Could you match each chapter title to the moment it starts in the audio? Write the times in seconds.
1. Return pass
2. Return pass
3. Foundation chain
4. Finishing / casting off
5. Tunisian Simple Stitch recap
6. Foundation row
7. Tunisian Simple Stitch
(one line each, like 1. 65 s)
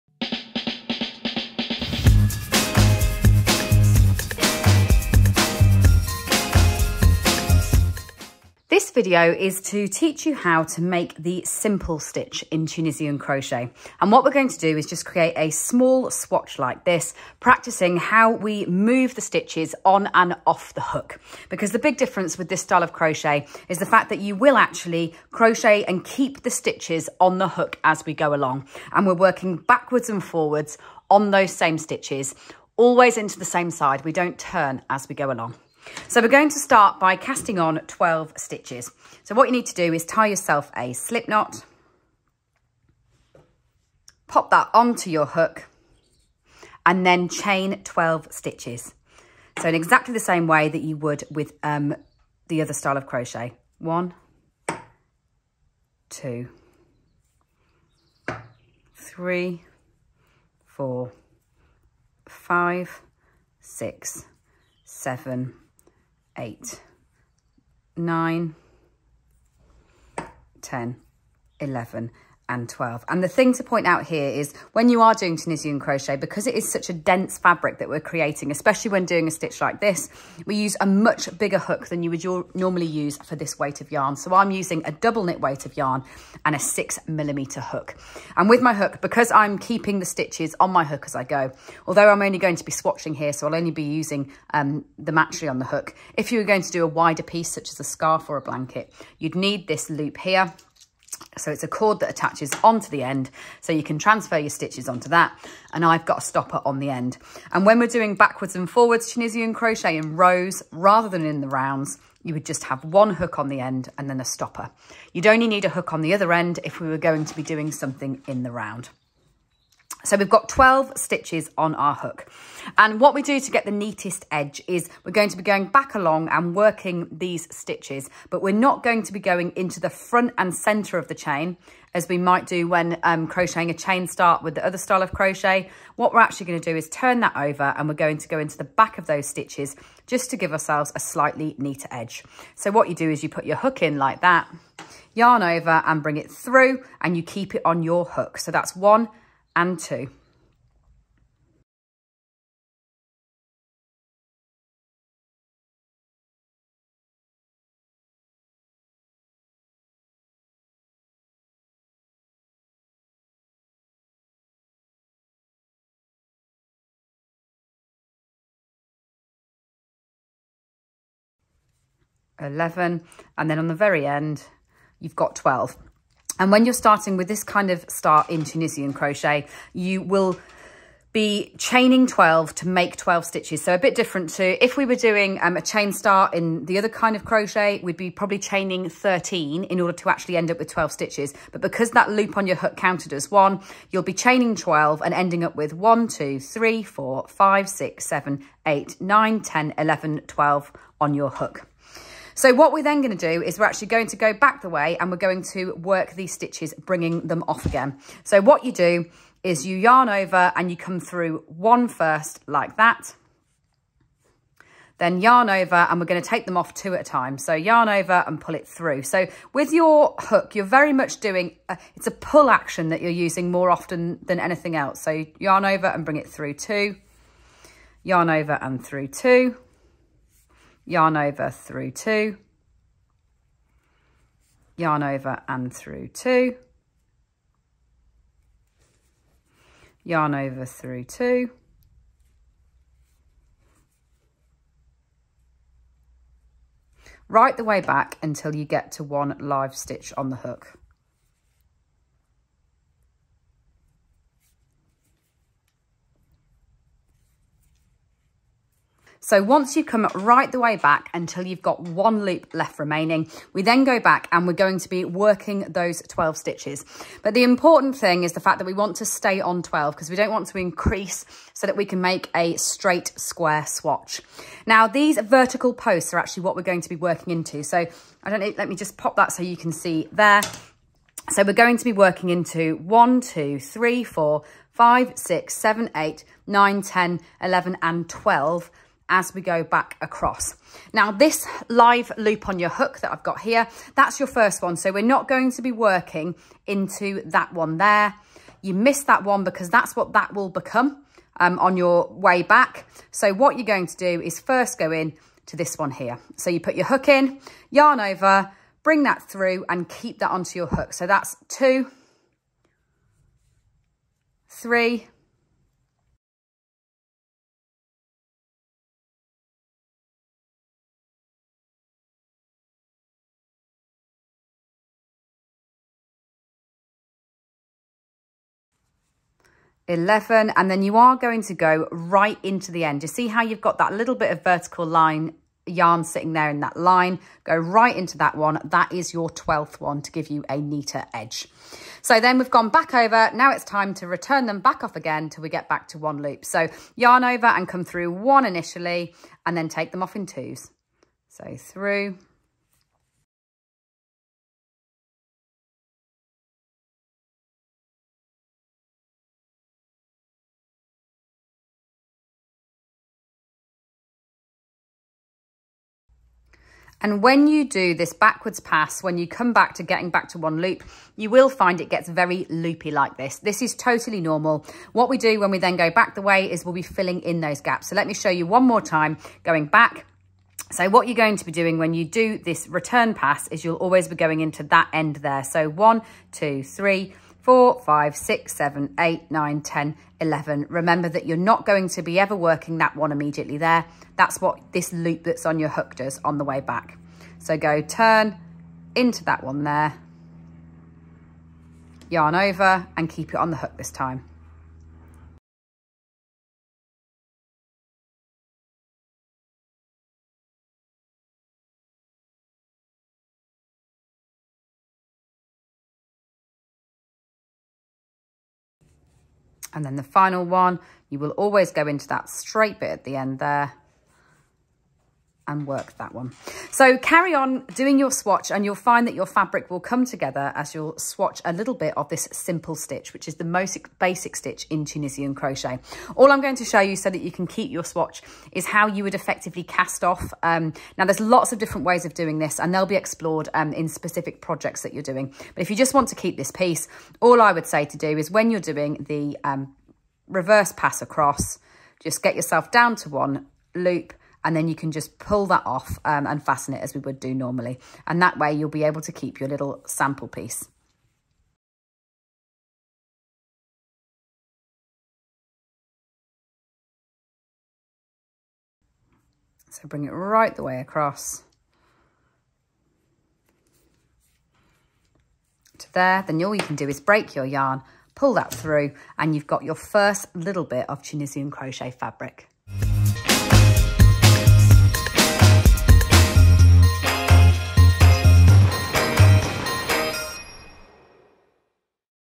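1. 341 s
2. 201 s
3. 35 s
4. 435 s
5. 377 s
6. 119 s
7. 258 s.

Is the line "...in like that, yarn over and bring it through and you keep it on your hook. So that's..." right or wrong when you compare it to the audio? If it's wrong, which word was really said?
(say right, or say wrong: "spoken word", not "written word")
right.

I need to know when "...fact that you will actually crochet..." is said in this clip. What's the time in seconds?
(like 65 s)
23 s.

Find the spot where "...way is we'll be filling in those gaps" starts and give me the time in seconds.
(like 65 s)
376 s.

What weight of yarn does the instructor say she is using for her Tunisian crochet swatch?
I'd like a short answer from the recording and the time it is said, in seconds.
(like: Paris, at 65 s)
double knit, at 84 s.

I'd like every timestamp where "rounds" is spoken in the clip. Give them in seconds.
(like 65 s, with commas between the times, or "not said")
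111 s, 118 s.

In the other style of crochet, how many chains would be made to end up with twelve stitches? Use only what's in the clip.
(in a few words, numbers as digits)
13.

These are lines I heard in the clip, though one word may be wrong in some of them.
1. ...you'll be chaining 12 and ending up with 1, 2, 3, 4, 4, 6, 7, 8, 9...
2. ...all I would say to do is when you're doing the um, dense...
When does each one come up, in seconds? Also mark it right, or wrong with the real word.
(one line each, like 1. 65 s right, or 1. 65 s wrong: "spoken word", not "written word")
1. 193 s wrong: "5", not "4"
2. 447 s wrong: "reverse", not "dense".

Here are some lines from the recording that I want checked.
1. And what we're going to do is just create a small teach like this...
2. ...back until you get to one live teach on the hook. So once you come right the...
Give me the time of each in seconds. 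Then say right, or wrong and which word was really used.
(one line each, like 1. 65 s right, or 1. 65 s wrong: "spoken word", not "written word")
1. 14 s wrong: "swatch", not "teach"
2. 247 s wrong: "stitch", not "teach".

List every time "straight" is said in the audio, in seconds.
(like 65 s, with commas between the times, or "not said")
272 s, 422 s.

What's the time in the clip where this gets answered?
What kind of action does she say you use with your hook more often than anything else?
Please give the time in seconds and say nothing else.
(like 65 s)
222 s.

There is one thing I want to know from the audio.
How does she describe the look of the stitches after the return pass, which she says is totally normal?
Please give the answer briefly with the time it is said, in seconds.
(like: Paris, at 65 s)
very loopy, at 372 s.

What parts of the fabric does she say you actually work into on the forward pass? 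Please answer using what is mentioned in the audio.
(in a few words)
vertical posts.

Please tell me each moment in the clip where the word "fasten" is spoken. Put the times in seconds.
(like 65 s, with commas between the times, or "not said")
456 s.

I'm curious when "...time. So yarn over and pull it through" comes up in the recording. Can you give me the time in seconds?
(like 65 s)
217 s.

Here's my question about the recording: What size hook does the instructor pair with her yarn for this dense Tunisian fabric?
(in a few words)
6 millimeter.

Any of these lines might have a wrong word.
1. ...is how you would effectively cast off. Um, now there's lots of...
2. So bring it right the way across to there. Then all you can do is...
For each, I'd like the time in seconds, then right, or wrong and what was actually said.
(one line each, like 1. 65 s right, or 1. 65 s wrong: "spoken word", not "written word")
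1. 438 s right
2. 469 s right.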